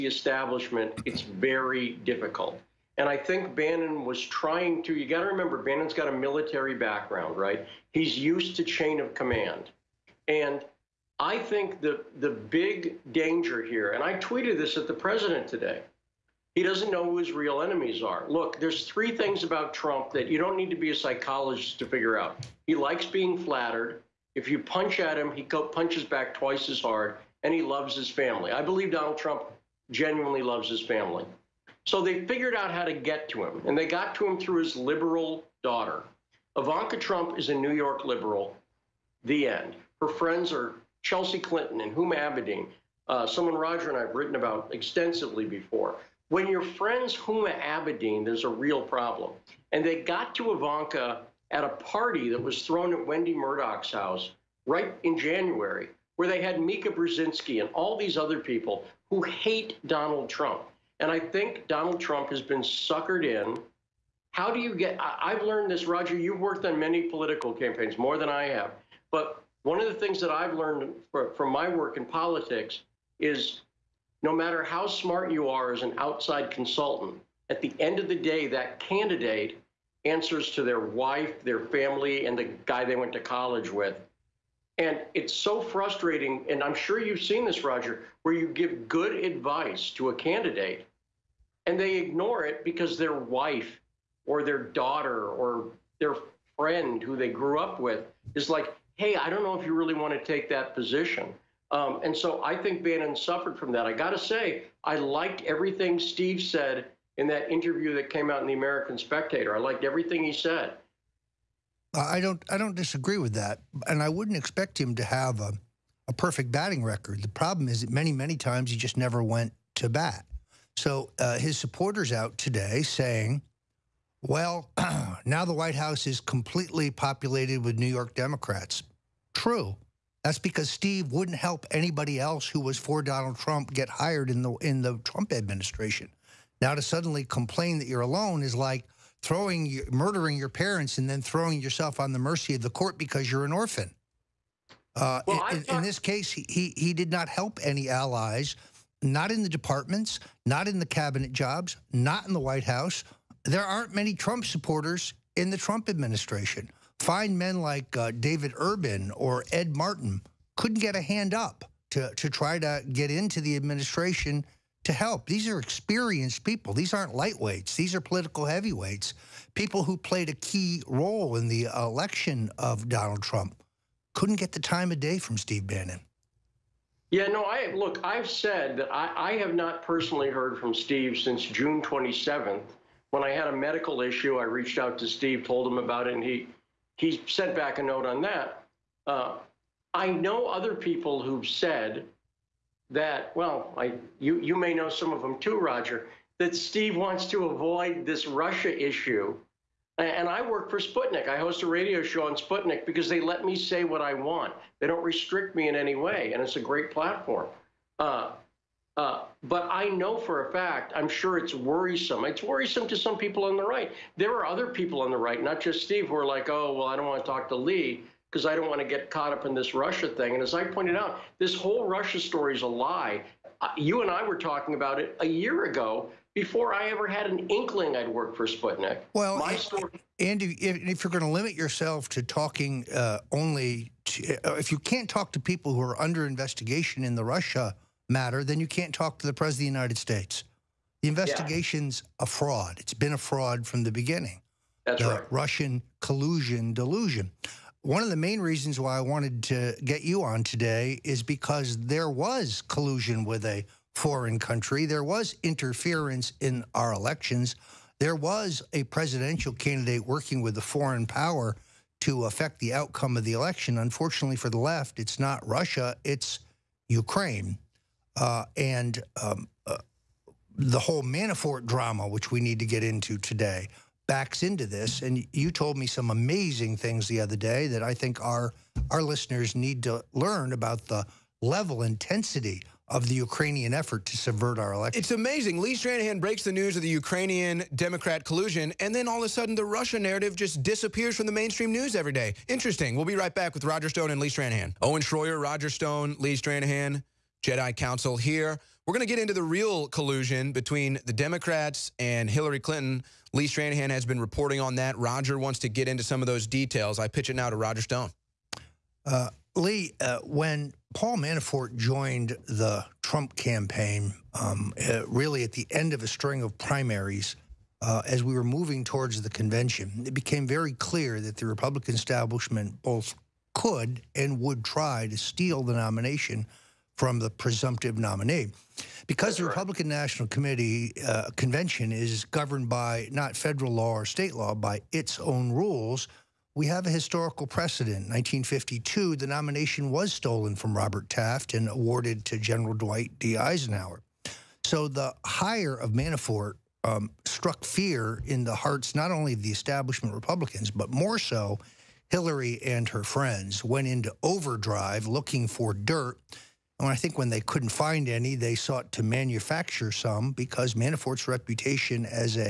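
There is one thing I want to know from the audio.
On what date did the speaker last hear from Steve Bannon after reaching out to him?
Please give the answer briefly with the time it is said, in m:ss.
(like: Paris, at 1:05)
June 27, at 3:01.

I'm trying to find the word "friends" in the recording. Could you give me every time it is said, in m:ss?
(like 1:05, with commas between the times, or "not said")
0:40, 0:46, 1:36, 5:53.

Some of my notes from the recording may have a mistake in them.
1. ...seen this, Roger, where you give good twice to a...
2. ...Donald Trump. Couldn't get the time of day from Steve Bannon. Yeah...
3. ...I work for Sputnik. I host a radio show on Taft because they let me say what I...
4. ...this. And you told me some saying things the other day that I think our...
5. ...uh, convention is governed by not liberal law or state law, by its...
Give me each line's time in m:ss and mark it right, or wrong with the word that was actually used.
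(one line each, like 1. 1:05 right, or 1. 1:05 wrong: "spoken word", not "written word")
1. 1:27 wrong: "advice", not "twice"
2. 2:52 right
3. 3:20 wrong: "Sputnik", not "Taft"
4. 4:34 wrong: "amazing", not "saying"
5. 5:31 wrong: "federal", not "liberal".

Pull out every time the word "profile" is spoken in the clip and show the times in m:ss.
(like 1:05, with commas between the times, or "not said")
not said.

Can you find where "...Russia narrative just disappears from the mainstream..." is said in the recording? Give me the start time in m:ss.
4:49.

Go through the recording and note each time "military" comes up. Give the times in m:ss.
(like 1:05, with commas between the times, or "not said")
0:06.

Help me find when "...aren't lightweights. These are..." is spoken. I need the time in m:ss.
2:46.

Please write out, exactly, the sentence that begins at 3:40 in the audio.
And as I pointed out, this whole Russia story is a lie.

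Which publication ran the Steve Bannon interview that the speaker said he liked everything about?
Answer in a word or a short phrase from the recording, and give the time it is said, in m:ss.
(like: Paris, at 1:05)
The American Spectator, at 1:48.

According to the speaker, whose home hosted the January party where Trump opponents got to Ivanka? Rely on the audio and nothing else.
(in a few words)
Wendy Murdoch.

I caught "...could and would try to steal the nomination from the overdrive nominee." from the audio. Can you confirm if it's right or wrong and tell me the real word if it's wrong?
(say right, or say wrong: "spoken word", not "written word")
wrong: "presumptive", not "overdrive".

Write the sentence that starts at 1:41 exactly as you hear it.
Um, and so I think Bannon suffered from that.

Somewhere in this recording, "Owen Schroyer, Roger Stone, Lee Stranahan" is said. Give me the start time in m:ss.
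4:54.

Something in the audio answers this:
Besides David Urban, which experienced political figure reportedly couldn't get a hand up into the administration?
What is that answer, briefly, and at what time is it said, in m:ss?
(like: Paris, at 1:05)
Ed Martin, at 2:39.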